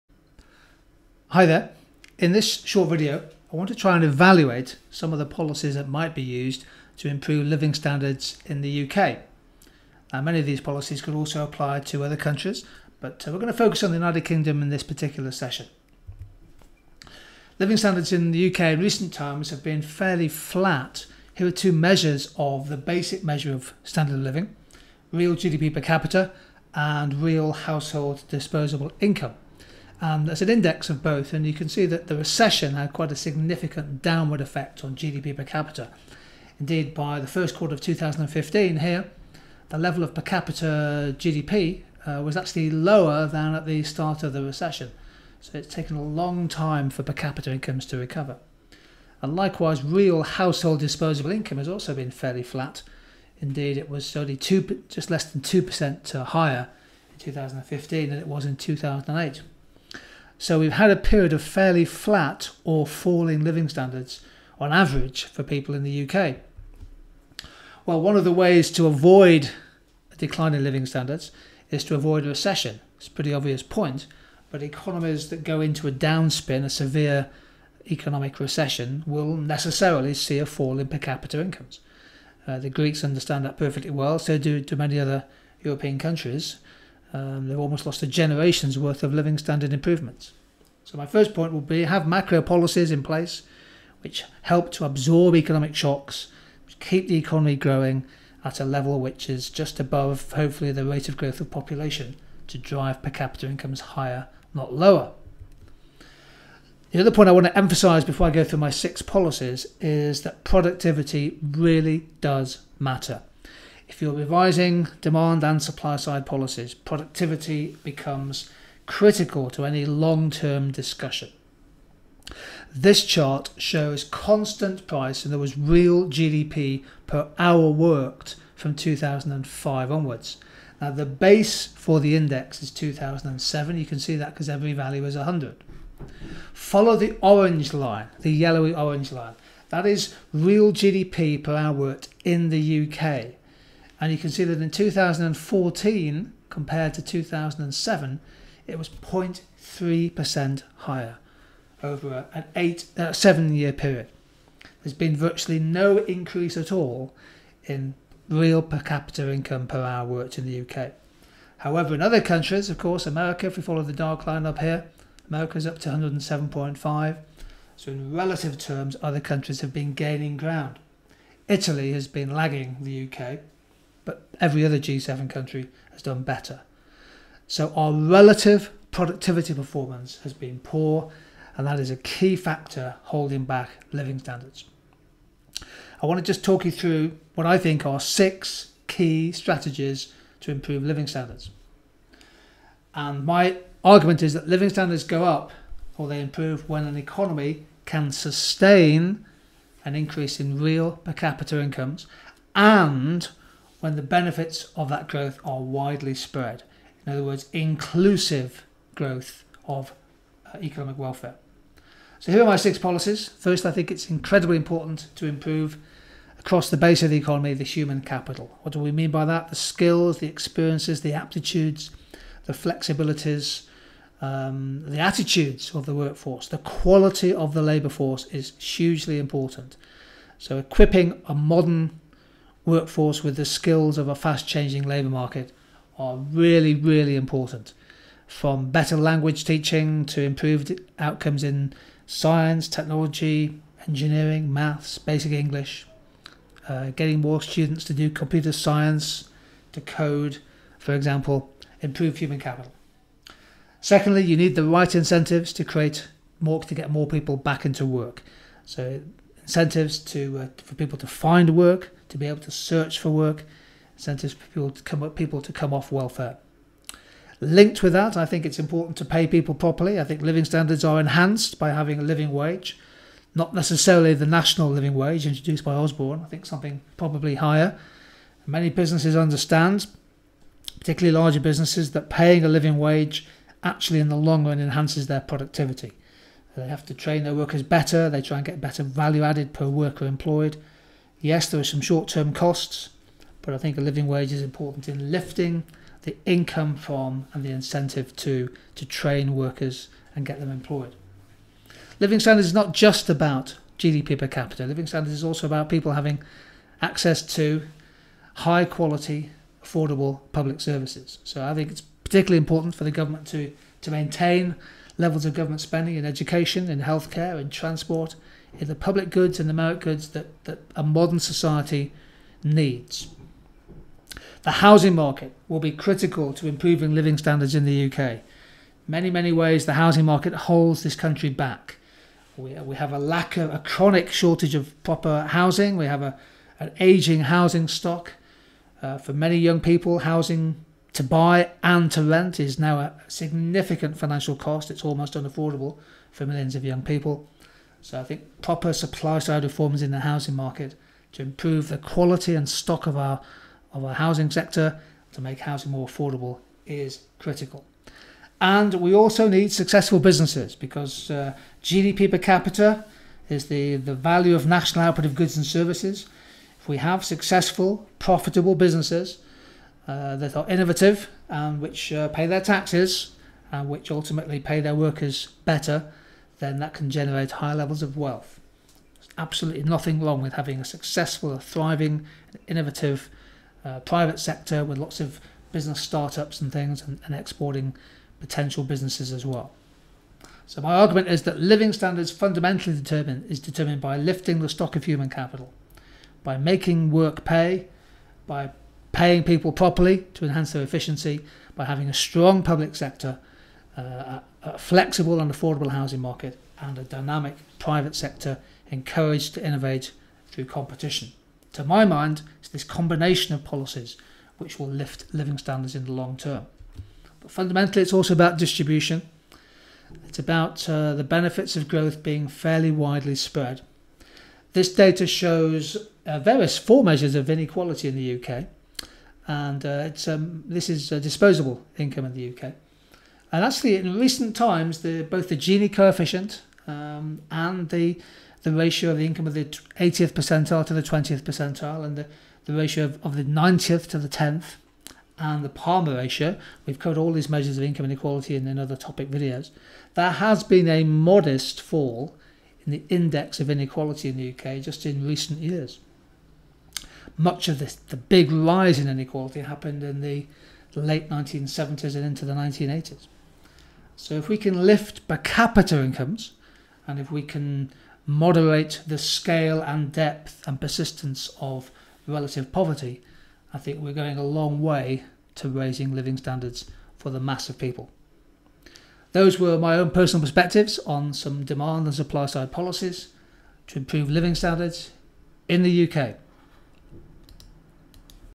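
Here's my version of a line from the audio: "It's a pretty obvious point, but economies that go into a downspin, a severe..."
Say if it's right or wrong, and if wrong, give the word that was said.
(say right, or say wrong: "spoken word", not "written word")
right.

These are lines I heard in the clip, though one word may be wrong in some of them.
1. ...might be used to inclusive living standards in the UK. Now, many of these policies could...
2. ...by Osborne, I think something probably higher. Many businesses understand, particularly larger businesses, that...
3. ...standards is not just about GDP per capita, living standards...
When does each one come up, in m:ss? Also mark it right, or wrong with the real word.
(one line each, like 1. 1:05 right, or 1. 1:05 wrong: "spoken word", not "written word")
1. 0:05 wrong: "improve", not "inclusive"
2. 4:35 right
3. 5:02 right.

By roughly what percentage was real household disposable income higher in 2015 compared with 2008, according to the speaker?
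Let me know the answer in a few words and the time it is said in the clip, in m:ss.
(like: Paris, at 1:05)
just less than 2%, at 0:54.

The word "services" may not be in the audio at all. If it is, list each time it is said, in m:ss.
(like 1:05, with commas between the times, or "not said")
5:10, 6:05.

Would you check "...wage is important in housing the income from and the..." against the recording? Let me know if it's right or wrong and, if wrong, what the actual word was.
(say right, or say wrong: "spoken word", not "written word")
wrong: "lifting", not "housing".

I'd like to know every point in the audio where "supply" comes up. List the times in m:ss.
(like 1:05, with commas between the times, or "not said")
1:55, 5:48, 8:01.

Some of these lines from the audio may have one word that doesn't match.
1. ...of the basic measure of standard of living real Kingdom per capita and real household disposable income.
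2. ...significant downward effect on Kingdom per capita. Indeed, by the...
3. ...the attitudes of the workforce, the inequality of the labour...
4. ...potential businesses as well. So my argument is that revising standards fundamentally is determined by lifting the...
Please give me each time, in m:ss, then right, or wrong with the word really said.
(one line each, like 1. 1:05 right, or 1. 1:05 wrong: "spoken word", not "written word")
1. 0:22 wrong: "GDP", not "Kingdom"
2. 0:33 wrong: "GDP", not "Kingdom"
3. 3:44 wrong: "quality", not "inequality"
4. 6:28 wrong: "living", not "revising".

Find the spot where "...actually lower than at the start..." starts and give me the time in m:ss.
0:42.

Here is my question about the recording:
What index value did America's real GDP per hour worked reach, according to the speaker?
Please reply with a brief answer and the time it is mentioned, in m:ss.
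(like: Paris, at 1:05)
107.5, at 2:45.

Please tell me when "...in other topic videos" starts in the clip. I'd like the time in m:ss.
7:28.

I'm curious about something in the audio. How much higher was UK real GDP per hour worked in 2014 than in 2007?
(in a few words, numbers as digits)
0.3%.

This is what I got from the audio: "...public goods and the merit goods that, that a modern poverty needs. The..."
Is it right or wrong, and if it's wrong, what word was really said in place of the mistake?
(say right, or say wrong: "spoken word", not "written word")
wrong: "society", not "poverty".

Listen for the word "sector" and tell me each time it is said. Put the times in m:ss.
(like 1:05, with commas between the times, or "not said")
5:54, 6:24, 6:42, 6:47.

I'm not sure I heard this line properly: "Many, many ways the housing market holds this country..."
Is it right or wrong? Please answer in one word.
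right.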